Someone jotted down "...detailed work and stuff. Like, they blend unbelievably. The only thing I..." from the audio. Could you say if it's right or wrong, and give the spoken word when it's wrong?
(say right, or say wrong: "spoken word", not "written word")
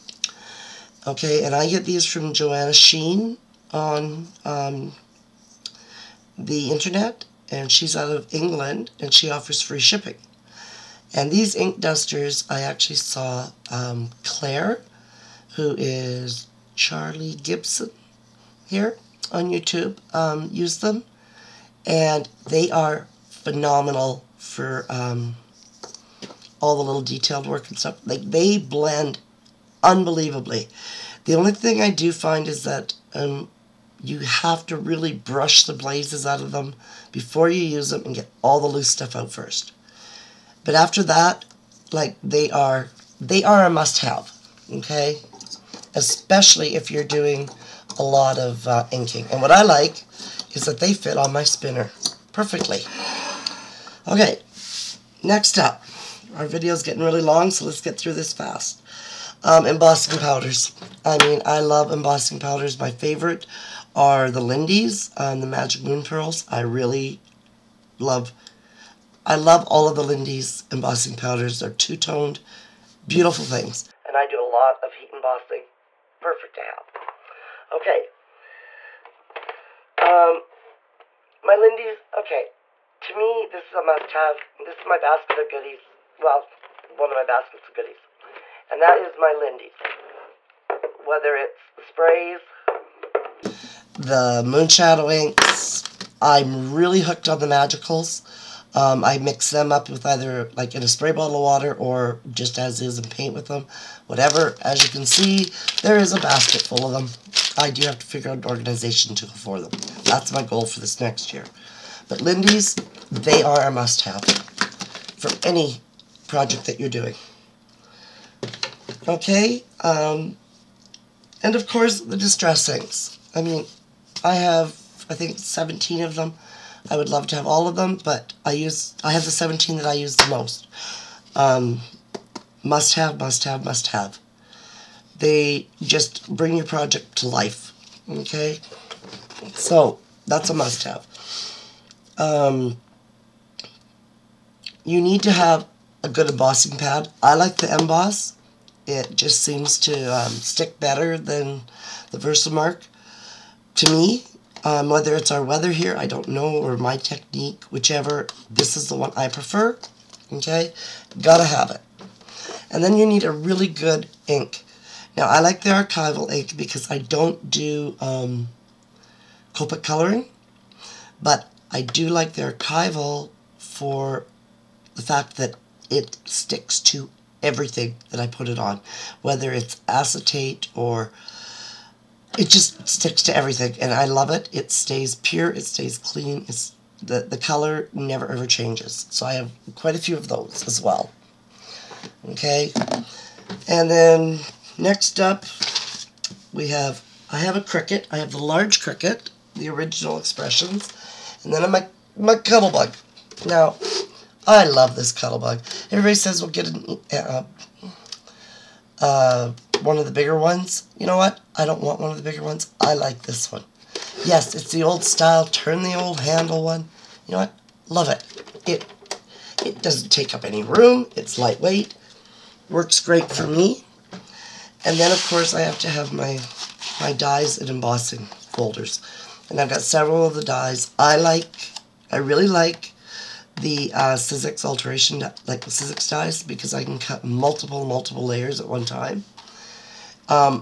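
right.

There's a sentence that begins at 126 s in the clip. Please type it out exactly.
I would love to have all of them, but I use I have the 17 that I use the most.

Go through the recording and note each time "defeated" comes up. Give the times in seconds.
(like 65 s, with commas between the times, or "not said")
not said.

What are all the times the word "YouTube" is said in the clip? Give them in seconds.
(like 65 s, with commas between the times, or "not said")
19 s.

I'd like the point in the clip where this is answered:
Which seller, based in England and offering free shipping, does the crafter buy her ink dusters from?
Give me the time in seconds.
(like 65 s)
2 s.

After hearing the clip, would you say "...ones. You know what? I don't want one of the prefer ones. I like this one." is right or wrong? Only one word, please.
wrong.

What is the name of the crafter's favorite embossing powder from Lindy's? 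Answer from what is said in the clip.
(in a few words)
Magic Moon Pearls.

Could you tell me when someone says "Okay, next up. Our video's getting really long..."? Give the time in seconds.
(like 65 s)
54 s.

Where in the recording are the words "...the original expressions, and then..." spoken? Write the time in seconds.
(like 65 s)
199 s.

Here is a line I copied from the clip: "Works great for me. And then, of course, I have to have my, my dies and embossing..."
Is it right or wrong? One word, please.
right.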